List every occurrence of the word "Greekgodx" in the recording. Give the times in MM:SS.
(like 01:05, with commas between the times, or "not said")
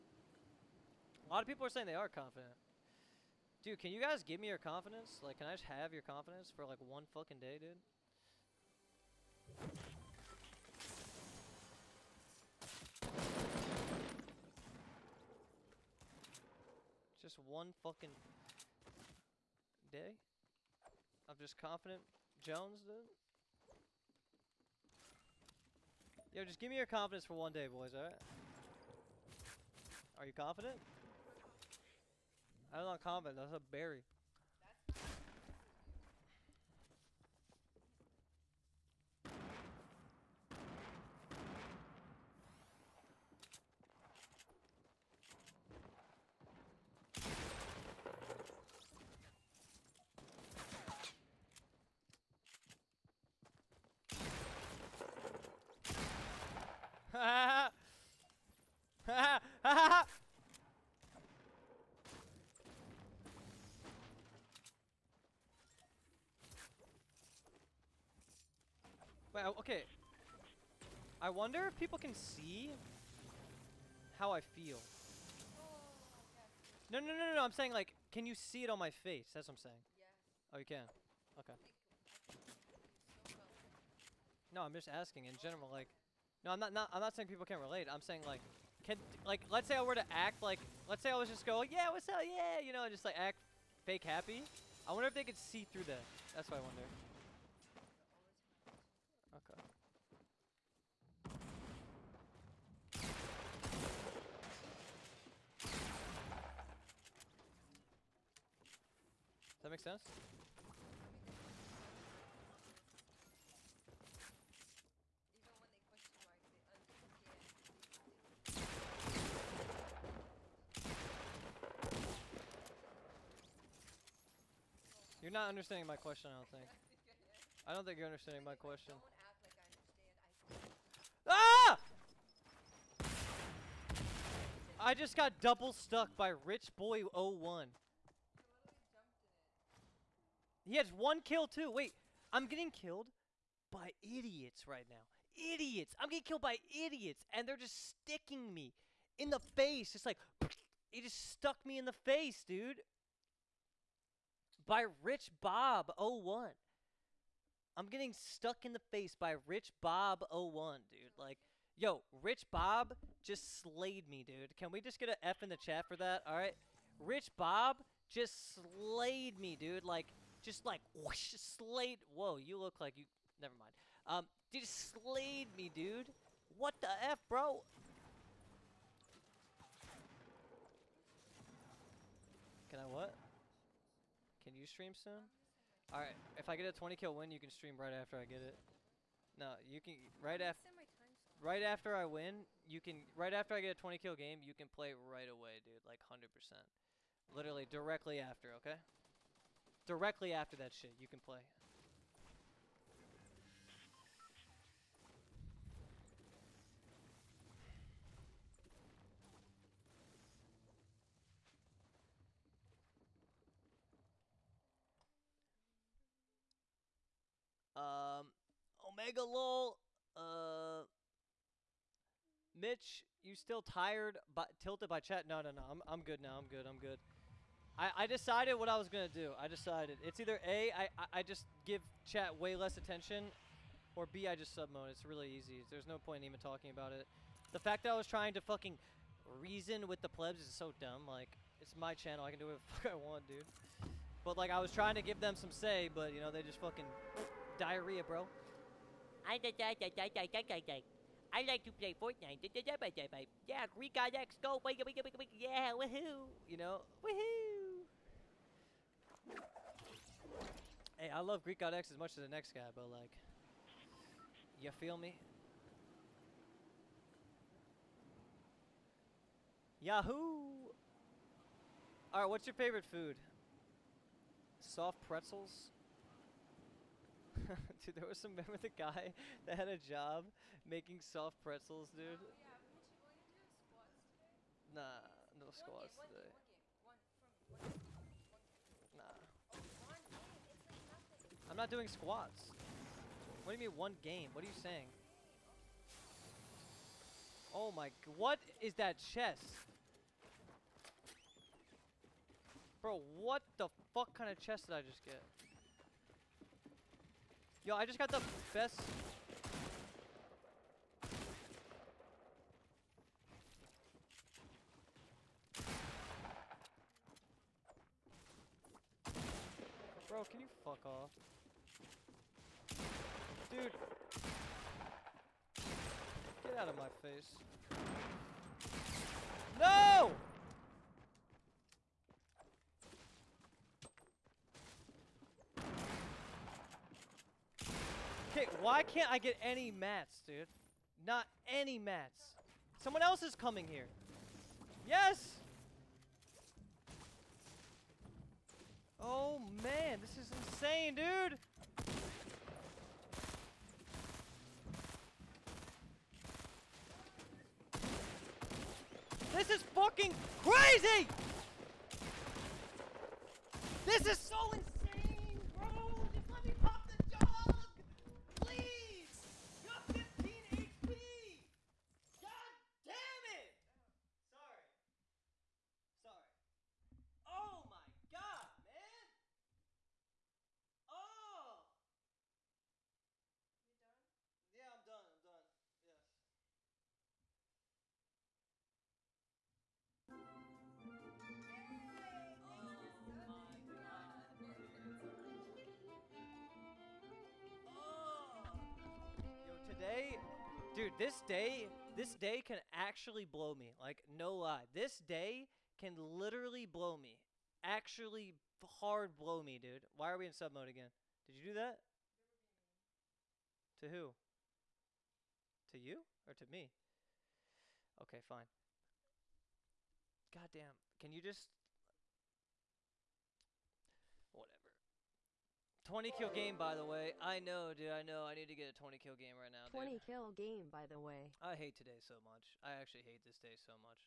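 04:13, 04:21.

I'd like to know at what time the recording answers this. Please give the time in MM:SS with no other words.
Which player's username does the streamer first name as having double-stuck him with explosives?
02:16.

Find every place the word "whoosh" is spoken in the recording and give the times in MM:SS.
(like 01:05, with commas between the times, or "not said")
02:50.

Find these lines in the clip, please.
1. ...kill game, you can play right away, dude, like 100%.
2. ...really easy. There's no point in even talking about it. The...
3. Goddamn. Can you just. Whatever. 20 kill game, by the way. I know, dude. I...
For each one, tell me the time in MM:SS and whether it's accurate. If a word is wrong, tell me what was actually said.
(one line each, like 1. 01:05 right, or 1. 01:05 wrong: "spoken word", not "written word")
1. 03:13 right
2. 03:55 right
3. 07:00 right.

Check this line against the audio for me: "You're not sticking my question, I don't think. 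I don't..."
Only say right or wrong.
wrong.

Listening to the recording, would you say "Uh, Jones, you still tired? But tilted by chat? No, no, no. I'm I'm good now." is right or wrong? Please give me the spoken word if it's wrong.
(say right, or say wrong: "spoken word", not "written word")
wrong: "Mitch", not "Jones".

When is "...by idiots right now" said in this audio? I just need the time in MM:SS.
02:23.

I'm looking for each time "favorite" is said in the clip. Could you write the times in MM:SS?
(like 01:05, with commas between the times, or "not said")
04:32.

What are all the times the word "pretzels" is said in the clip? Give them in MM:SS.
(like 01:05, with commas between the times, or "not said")
04:35, 04:41.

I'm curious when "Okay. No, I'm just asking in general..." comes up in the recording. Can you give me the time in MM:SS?
01:21.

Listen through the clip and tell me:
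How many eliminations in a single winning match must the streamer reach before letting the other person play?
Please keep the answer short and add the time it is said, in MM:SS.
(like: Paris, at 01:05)
20, at 03:06.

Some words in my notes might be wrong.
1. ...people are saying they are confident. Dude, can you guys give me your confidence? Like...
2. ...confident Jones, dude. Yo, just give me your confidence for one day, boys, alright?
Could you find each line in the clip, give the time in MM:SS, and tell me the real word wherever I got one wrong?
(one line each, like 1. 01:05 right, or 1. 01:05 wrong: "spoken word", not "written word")
1. 00:01 right
2. 00:21 right.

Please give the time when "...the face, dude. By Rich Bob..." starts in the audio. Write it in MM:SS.
02:31.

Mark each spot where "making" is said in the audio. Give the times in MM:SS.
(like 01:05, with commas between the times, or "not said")
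04:40.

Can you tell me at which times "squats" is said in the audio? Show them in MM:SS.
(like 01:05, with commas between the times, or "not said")
04:45, 04:51.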